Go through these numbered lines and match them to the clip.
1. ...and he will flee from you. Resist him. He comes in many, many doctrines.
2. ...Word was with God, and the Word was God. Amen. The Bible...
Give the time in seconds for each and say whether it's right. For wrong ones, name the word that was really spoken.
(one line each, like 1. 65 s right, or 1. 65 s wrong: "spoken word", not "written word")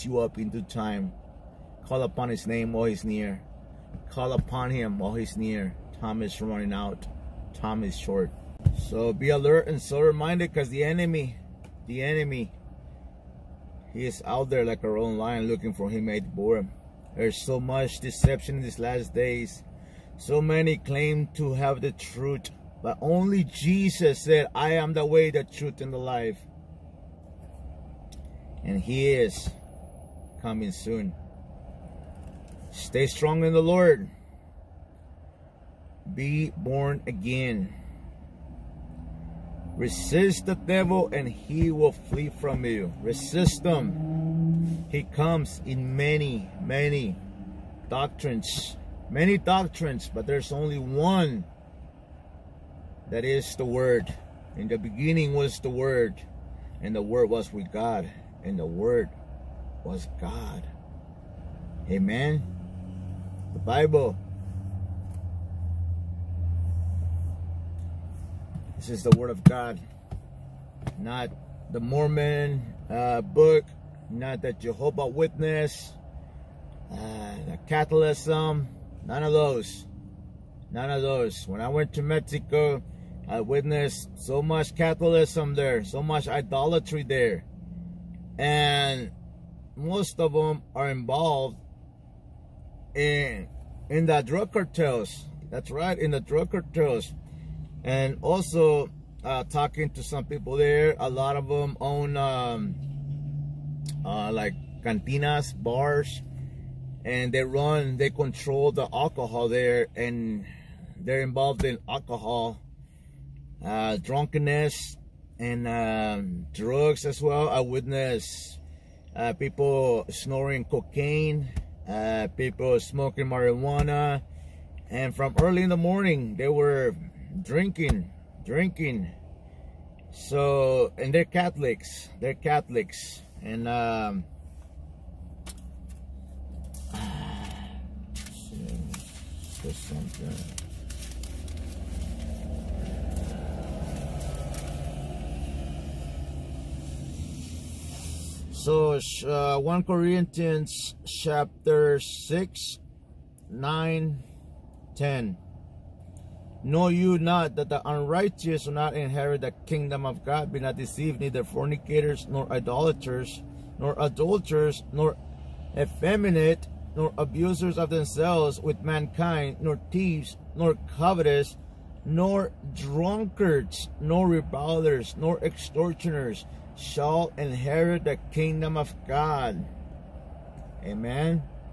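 1. 41 s right
2. 57 s right.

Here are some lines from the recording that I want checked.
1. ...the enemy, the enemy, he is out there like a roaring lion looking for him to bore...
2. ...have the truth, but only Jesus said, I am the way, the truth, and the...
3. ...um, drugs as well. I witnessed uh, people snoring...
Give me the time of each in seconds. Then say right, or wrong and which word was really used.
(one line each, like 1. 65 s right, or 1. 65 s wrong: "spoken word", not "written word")
1. 10 s right
2. 21 s right
3. 115 s right.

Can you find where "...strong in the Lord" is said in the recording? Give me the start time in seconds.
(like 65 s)
33 s.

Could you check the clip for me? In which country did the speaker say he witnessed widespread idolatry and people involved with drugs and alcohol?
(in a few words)
Mexico.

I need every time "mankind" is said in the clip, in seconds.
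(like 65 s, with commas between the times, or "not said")
168 s.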